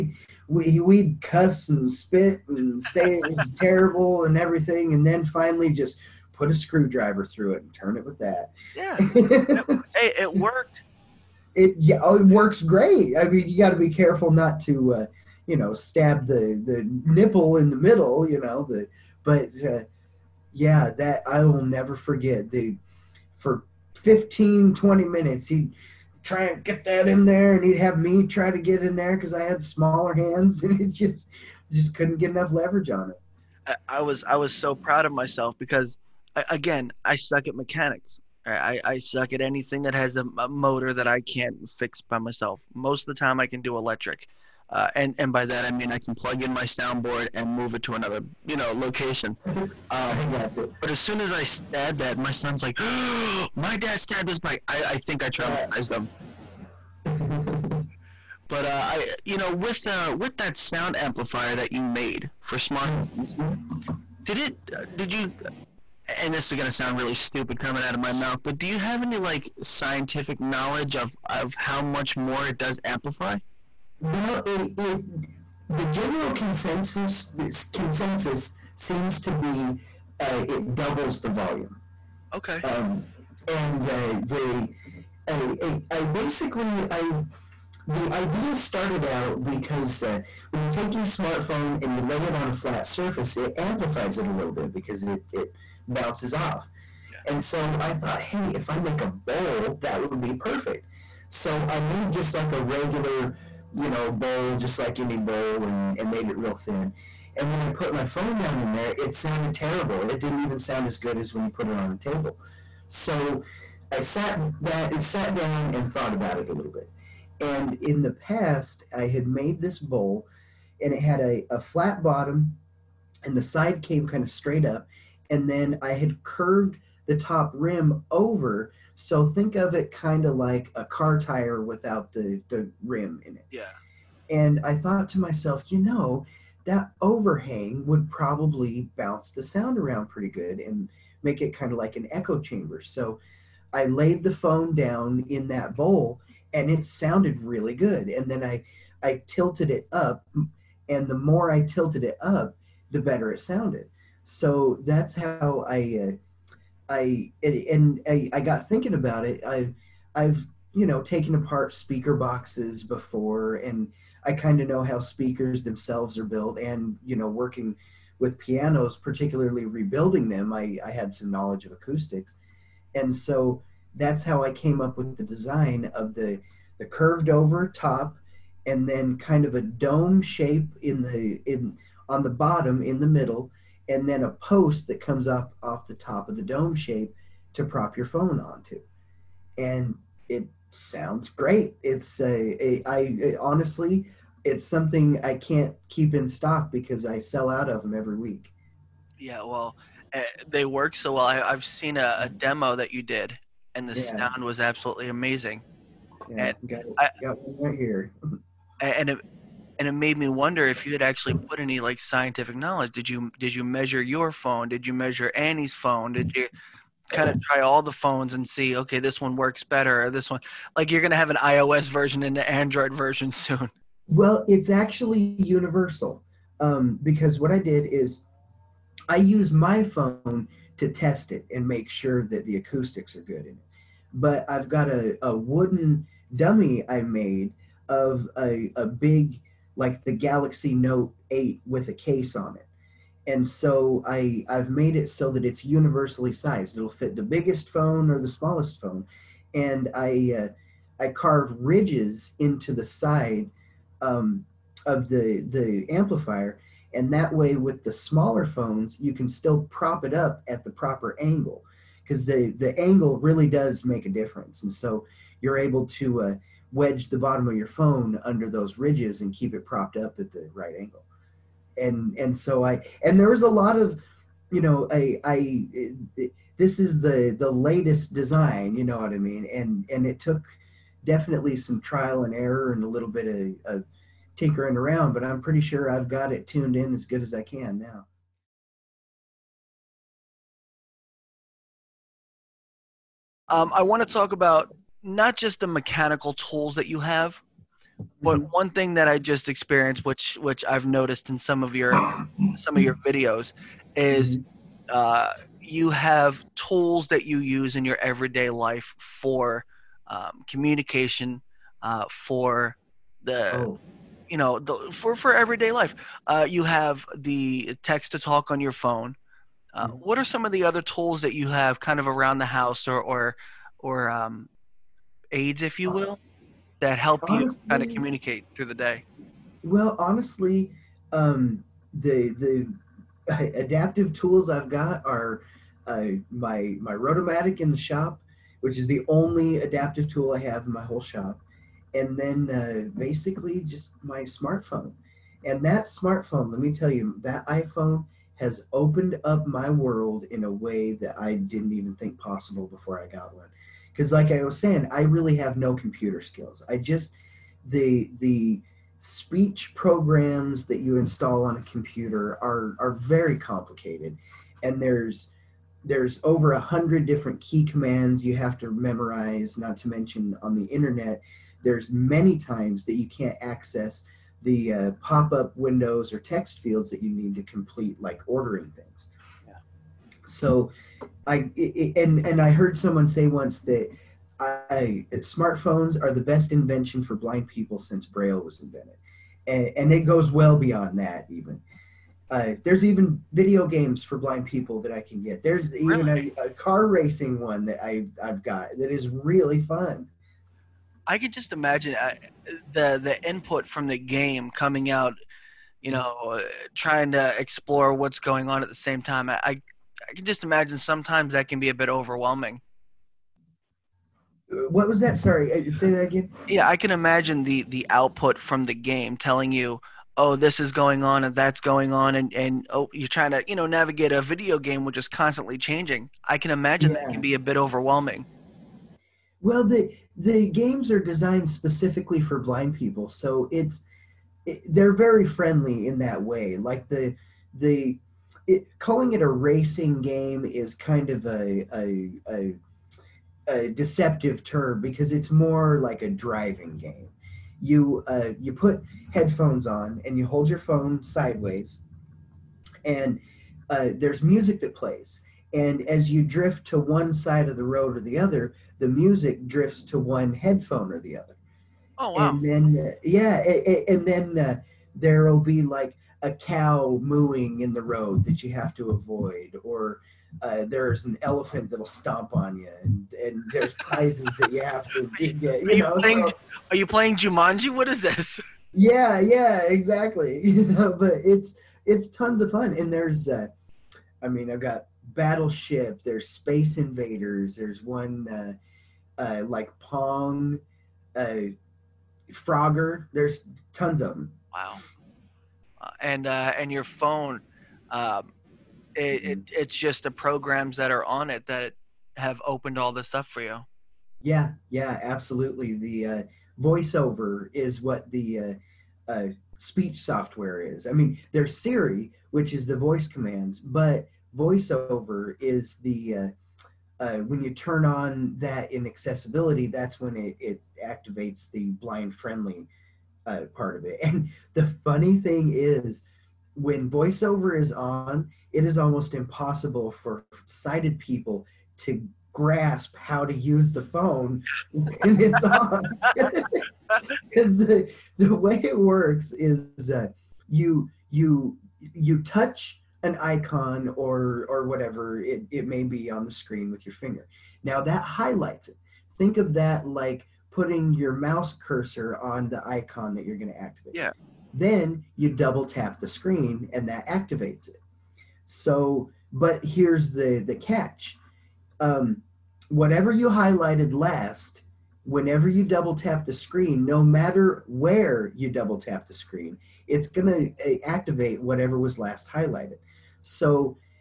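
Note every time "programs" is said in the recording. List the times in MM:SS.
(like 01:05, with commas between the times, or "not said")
05:59, 08:20.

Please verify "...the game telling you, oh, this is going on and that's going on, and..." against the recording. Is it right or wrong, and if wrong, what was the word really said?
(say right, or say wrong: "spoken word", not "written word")
right.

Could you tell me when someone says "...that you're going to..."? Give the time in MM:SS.
09:13.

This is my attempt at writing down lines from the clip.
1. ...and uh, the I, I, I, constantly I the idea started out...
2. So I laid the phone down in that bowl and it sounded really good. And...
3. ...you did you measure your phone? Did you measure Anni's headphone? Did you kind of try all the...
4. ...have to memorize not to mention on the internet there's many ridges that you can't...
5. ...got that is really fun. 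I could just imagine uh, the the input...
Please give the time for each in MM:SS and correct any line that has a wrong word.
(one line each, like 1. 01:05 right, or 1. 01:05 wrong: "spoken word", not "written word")
1. 01:23 wrong: "basically", not "constantly"
2. 02:22 right
3. 03:33 wrong: "phone", not "headphone"
4. 06:08 wrong: "times", not "ridges"
5. 06:38 right.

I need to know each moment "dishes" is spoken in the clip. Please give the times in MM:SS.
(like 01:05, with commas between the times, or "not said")
not said.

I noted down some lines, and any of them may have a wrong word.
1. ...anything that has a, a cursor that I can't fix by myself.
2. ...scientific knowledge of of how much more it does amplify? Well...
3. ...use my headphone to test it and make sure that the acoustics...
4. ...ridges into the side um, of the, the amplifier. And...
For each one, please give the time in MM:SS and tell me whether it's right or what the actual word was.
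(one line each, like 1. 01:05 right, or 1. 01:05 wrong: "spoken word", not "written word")
1. 00:39 wrong: "motor", not "cursor"
2. 01:09 right
3. 03:49 wrong: "phone", not "headphone"
4. 04:11 right.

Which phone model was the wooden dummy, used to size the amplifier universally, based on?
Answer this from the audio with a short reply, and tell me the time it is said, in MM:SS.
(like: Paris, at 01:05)
Galaxy Note 8, at 04:00.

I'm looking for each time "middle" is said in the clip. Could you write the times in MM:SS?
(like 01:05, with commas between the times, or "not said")
00:17, 03:03.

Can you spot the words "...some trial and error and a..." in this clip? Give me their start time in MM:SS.
04:41.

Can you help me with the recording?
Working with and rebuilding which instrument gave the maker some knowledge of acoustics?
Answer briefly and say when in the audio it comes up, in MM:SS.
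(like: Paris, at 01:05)
Pianos, at 02:48.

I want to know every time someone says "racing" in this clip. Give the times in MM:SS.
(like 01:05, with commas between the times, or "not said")
06:36, 07:19.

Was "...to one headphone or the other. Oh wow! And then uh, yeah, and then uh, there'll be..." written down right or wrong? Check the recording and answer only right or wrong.
right.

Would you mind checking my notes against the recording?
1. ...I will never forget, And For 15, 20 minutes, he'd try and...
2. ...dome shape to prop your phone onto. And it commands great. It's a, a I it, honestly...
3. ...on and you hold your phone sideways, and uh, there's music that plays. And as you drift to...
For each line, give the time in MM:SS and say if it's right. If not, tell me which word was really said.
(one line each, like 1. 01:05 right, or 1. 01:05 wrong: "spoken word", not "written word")
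1. 00:21 wrong: "The", not "And"
2. 03:06 wrong: "sounds", not "commands"
3. 07:29 right.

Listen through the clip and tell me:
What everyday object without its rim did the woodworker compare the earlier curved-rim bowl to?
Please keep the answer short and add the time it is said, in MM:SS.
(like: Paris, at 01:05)
Car tire, at 02:10.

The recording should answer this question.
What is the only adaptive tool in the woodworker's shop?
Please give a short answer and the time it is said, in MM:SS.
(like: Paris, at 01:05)
Rotomatic, at 05:36.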